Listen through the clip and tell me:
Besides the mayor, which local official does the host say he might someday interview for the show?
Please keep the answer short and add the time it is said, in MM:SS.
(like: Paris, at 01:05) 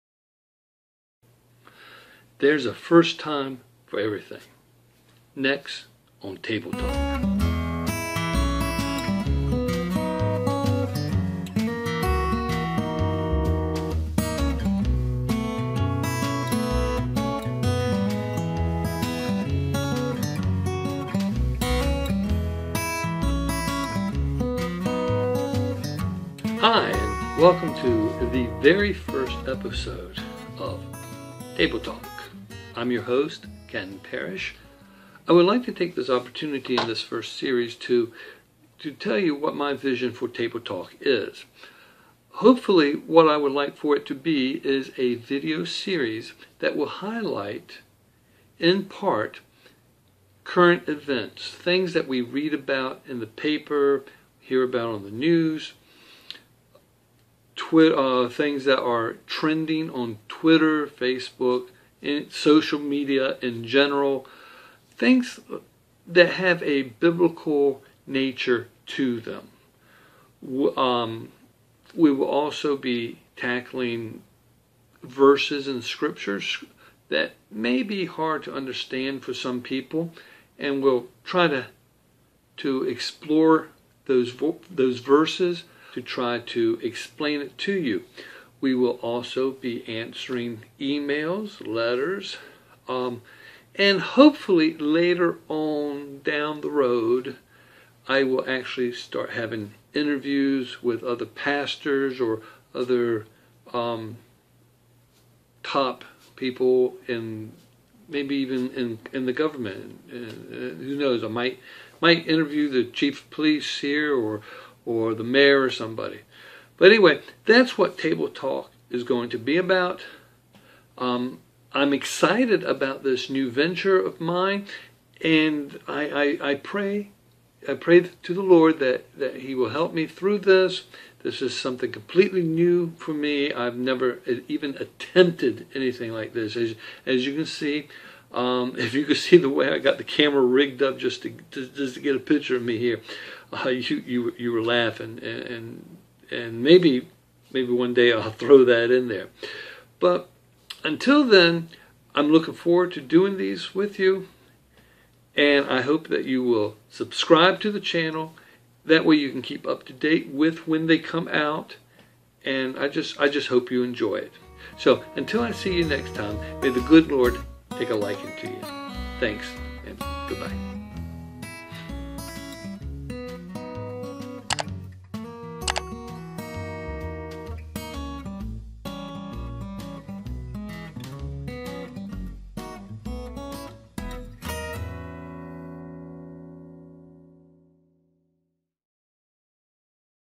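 chief of police, at 01:52.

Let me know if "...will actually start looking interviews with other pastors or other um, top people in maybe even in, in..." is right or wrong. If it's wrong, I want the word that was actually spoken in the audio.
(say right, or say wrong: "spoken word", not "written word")
wrong: "having", not "looking".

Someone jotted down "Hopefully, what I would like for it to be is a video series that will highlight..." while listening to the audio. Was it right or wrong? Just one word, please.
right.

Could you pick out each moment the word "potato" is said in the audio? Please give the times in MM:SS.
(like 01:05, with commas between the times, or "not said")
not said.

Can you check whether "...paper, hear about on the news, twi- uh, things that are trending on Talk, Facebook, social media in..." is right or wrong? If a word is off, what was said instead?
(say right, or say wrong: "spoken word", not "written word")
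wrong: "Twitter", not "Talk".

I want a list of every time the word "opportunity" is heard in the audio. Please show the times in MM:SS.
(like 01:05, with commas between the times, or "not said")
00:36.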